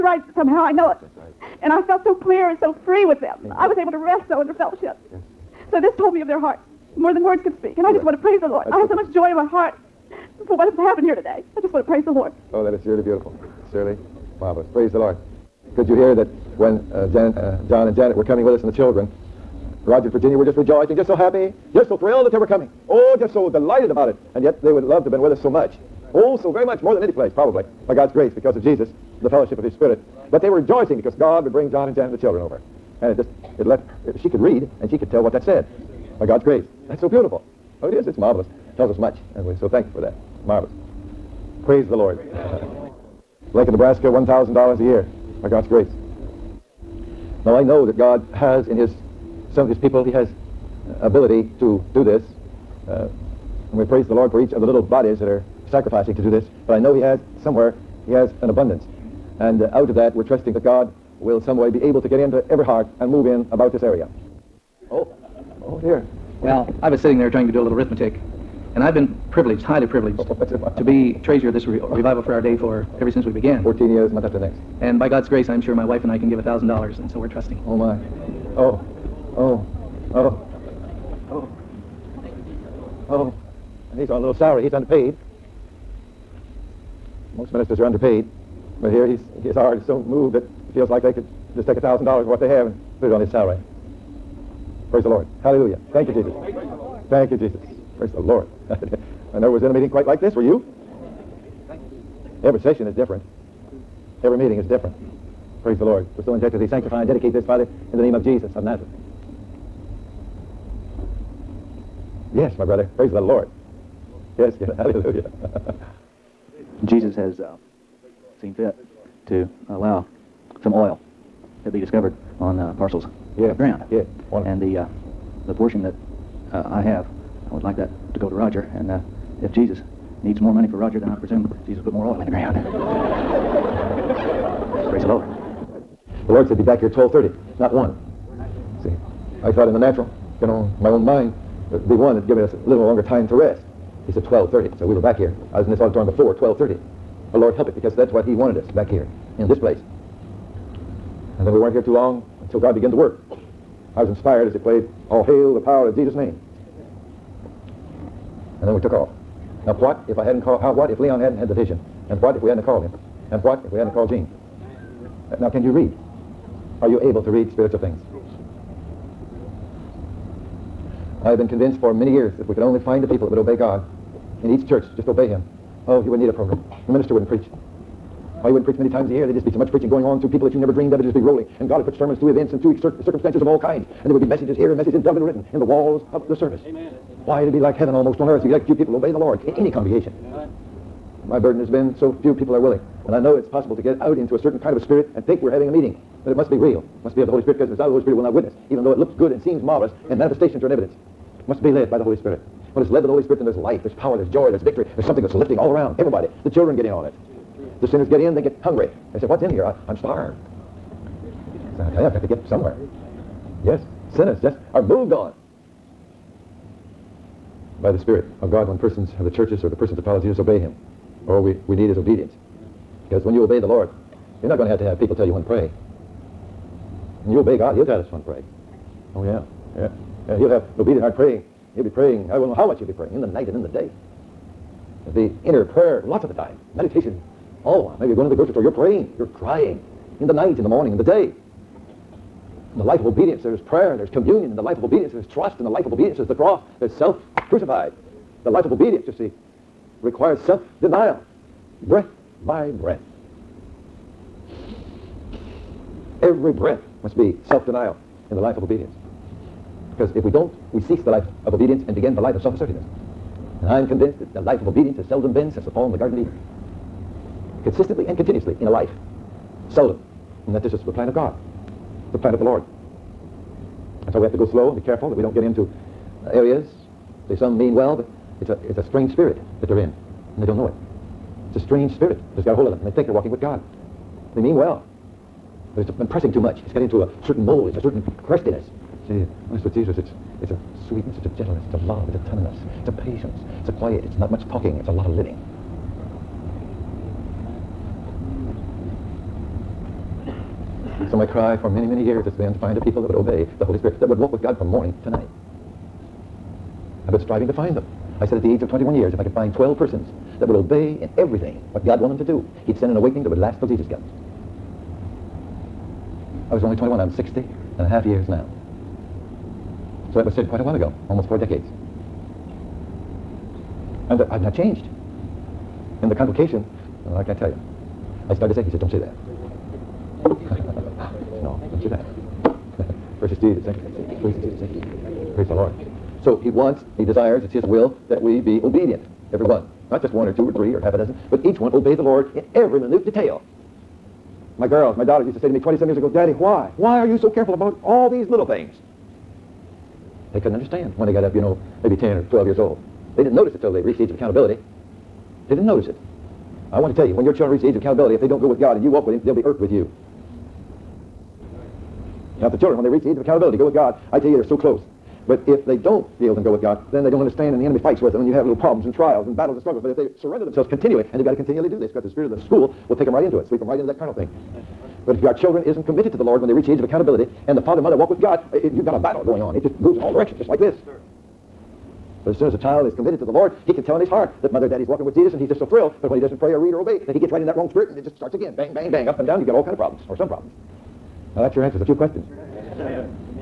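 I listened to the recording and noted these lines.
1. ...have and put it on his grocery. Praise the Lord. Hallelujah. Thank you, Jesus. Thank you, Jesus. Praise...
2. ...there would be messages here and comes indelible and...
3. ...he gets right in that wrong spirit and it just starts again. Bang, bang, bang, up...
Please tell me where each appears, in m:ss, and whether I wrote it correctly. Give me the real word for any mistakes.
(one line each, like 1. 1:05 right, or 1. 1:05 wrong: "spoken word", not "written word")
1. 1:32 wrong: "salary", not "grocery"
2. 3:04 wrong: "messages", not "comes"
3. 6:27 right.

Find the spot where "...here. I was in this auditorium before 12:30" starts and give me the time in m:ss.
2:25.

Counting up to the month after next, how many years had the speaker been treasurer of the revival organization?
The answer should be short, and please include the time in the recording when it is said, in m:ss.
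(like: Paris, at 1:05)
14, at 1:13.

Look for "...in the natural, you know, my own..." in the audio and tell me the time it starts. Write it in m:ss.
2:19.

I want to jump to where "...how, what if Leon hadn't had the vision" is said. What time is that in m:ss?
2:40.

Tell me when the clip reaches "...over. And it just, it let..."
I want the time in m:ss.
0:32.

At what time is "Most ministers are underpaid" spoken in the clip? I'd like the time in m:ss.
1:27.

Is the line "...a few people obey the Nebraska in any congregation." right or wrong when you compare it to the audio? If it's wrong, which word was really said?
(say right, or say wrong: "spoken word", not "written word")
wrong: "Lord", not "Nebraska".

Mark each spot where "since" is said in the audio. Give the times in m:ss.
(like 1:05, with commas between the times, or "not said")
1:13, 4:25.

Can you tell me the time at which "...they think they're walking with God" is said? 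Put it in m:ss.
4:42.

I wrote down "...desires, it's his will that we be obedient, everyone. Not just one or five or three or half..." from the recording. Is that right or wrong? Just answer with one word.
wrong.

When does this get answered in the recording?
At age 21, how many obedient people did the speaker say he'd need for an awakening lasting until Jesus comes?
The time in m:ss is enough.
5:09.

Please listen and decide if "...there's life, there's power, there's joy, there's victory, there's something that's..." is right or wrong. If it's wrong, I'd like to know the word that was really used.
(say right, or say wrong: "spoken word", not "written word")
right.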